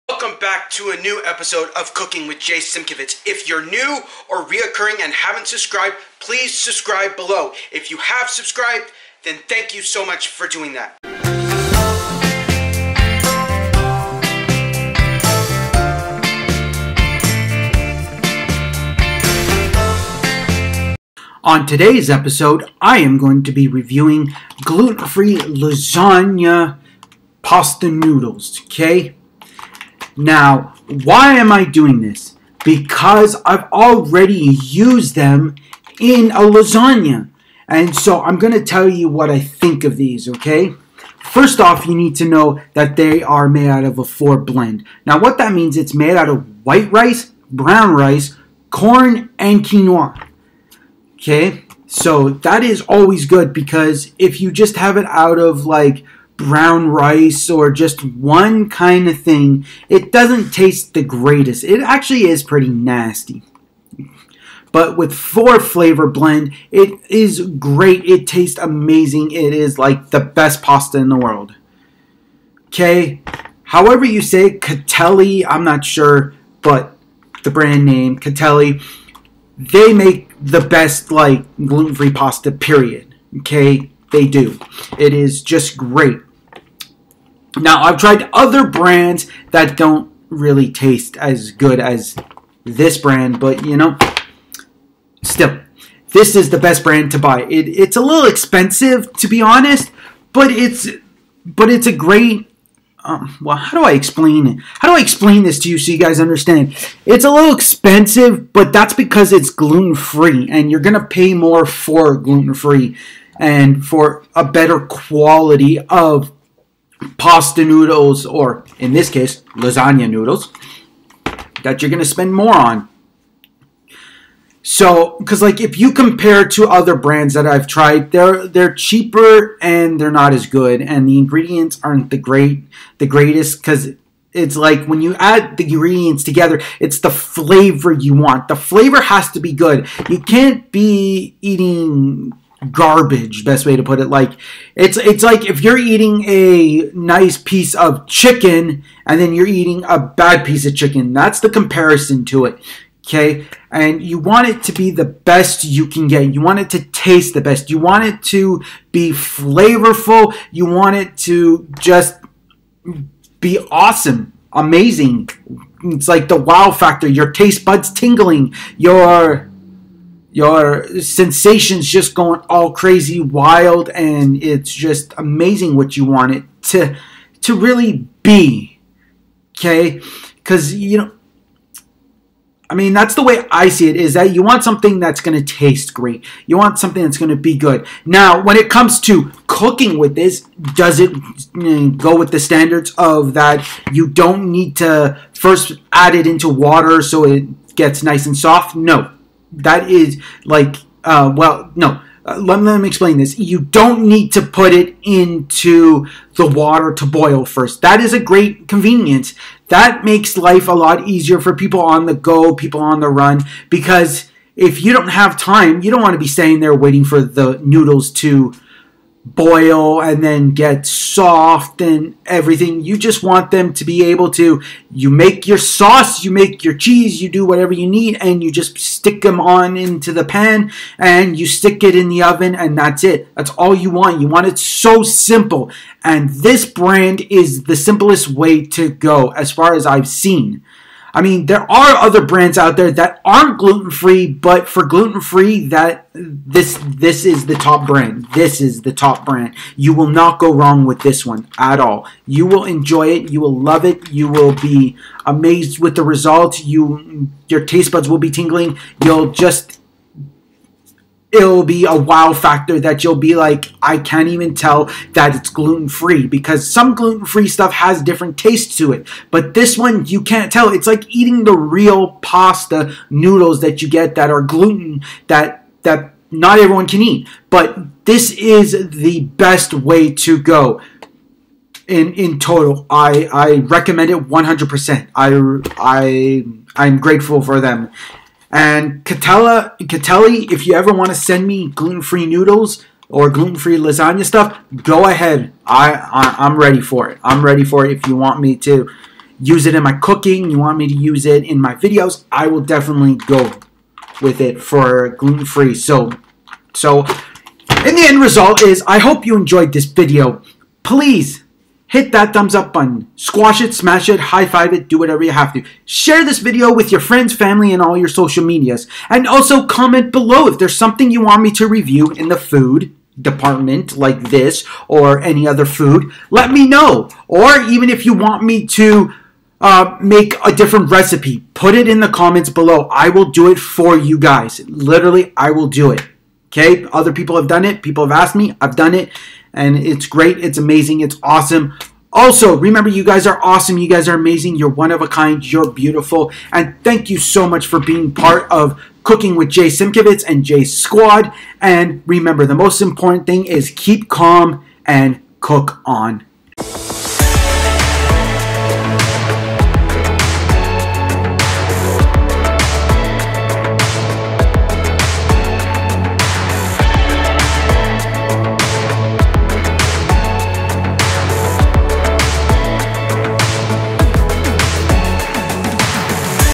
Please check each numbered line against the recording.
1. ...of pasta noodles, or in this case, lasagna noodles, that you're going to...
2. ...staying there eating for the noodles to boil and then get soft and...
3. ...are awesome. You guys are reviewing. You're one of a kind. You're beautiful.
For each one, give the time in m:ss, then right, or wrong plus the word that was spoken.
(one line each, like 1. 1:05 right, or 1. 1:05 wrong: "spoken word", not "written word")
1. 1:55 right
2. 3:36 wrong: "waiting", not "eating"
3. 5:43 wrong: "amazing", not "reviewing".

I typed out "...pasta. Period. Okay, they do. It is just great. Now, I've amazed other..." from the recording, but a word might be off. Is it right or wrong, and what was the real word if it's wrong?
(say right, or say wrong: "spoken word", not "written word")
wrong: "tried", not "amazed".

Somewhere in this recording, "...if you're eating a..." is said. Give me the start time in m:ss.
2:25.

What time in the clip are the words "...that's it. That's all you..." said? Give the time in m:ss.
3:52.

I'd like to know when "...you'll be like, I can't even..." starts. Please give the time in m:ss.
4:23.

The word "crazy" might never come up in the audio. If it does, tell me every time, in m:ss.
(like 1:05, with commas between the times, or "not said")
2:52.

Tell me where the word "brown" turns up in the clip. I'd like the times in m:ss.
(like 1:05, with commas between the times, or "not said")
0:47, 0:56.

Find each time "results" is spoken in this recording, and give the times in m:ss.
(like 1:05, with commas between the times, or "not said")
4:16, 5:08.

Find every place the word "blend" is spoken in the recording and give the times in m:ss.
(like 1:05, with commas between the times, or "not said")
0:44, 1:06.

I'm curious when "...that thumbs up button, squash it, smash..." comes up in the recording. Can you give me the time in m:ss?
5:12.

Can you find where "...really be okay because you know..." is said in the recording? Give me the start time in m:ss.
2:57.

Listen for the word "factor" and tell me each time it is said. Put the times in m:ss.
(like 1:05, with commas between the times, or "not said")
2:46, 4:22.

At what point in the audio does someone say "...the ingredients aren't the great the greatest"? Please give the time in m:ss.
2:11.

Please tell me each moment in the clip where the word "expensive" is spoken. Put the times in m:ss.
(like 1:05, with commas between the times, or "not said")
1:38, 1:47.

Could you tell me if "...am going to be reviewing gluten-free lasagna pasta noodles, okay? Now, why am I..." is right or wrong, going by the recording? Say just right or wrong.
right.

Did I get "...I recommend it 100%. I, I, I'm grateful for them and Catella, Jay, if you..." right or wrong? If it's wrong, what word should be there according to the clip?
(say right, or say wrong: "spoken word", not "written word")
wrong: "Catelli", not "Jay".